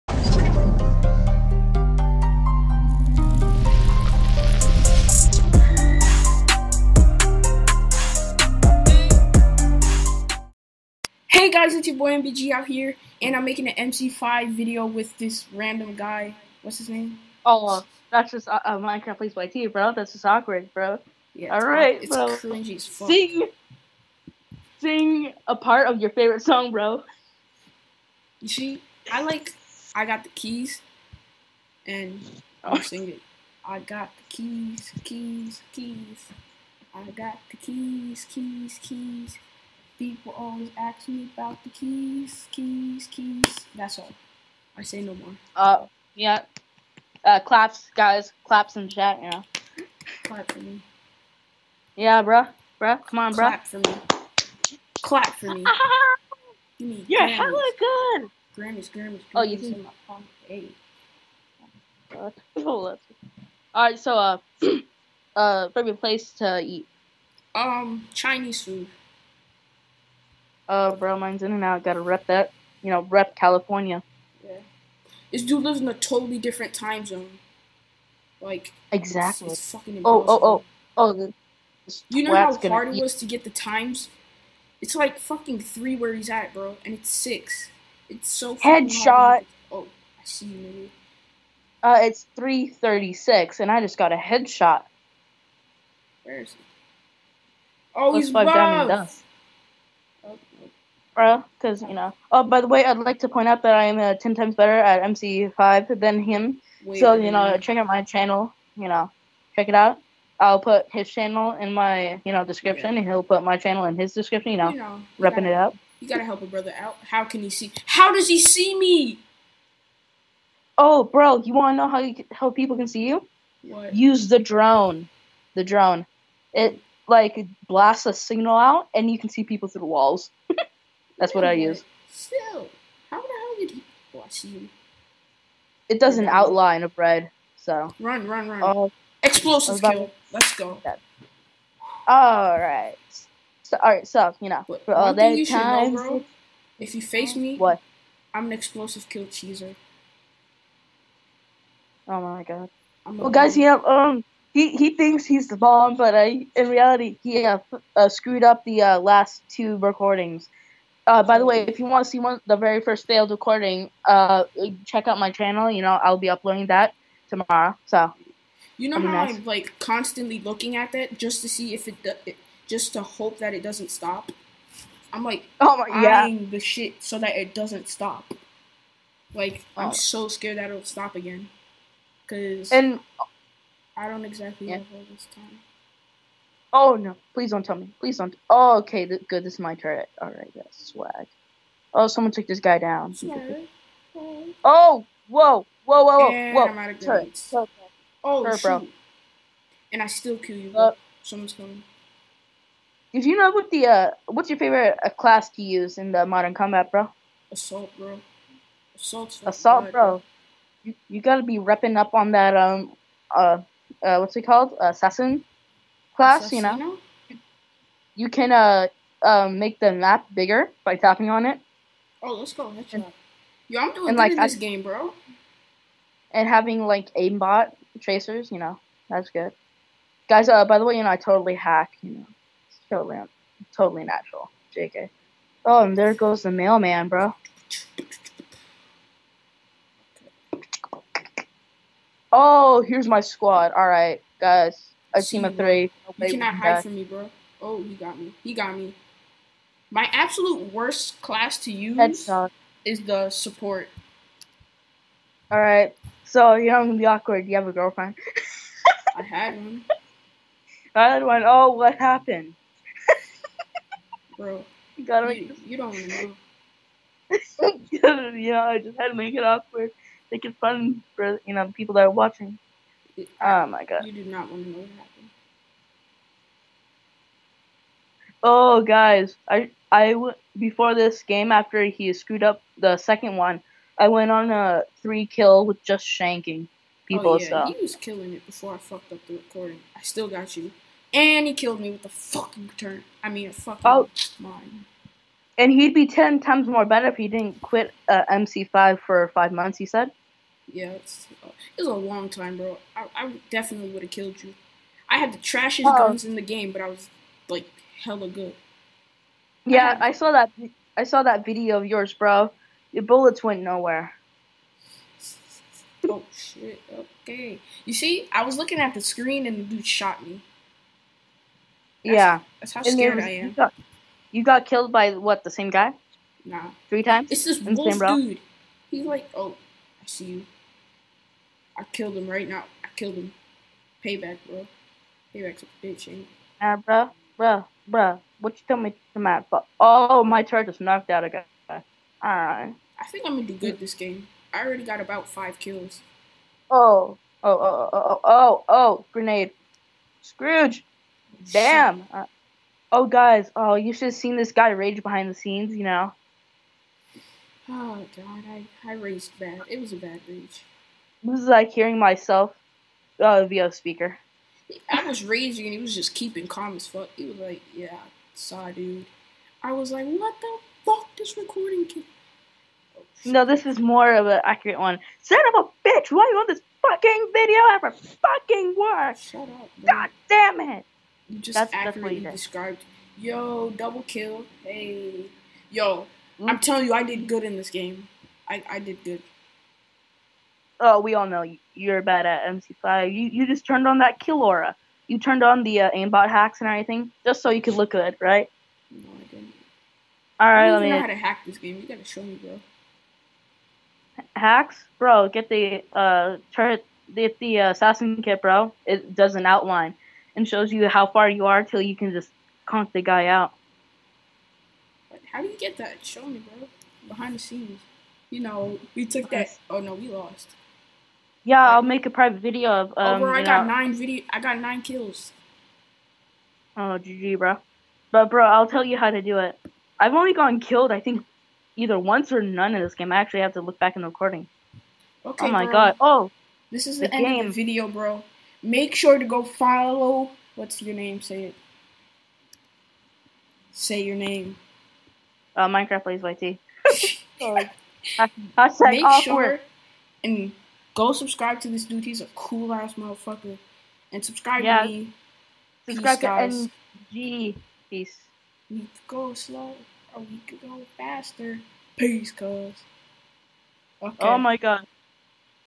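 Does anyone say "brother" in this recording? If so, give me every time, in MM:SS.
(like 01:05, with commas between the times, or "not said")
01:56.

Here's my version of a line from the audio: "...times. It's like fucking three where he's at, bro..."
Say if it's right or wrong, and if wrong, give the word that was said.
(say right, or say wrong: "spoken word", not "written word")
right.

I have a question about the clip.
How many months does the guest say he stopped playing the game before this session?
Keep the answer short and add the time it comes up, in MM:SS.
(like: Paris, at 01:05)
5, at 04:59.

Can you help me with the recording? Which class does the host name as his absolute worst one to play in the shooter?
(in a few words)
Support.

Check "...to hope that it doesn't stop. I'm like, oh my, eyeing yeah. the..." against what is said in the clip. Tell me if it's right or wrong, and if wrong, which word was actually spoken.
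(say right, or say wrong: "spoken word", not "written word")
right.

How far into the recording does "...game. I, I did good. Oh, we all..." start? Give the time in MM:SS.
06:27.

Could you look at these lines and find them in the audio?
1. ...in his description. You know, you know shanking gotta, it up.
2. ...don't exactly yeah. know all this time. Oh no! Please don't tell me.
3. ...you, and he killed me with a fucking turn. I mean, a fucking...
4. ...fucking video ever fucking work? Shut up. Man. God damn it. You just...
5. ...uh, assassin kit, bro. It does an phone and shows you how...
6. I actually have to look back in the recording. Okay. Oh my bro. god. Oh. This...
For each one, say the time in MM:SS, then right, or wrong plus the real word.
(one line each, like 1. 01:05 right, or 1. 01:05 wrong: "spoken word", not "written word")
1. 01:53 wrong: "repping", not "shanking"
2. 03:04 right
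3. 04:50 right
4. 06:16 right
5. 06:47 wrong: "outline", not "phone"
6. 07:13 right.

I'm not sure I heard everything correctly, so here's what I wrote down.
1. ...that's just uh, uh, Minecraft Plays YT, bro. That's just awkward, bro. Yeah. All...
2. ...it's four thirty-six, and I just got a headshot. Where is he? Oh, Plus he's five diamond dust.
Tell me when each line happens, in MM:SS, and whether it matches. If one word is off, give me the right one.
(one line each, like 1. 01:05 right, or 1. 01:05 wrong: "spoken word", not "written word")
1. 00:18 right
2. 01:32 wrong: "three", not "four".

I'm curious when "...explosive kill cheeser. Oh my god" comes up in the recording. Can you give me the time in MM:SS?
02:28.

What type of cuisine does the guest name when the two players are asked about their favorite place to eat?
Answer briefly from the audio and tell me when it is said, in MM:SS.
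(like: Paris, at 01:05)
Chinese food, at 01:08.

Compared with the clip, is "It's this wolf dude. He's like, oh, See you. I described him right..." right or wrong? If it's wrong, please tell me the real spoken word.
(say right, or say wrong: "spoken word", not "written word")
wrong: "killed", not "described".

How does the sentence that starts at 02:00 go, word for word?
Oh, bro, you wanna know how you, how people can see you?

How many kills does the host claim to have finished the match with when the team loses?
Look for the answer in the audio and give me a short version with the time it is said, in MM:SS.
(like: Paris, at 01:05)
9, at 07:04.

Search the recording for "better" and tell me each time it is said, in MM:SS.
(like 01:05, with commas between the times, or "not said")
01:44, 04:56.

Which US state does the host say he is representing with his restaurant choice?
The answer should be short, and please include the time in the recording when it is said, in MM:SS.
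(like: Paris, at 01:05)
California, at 01:13.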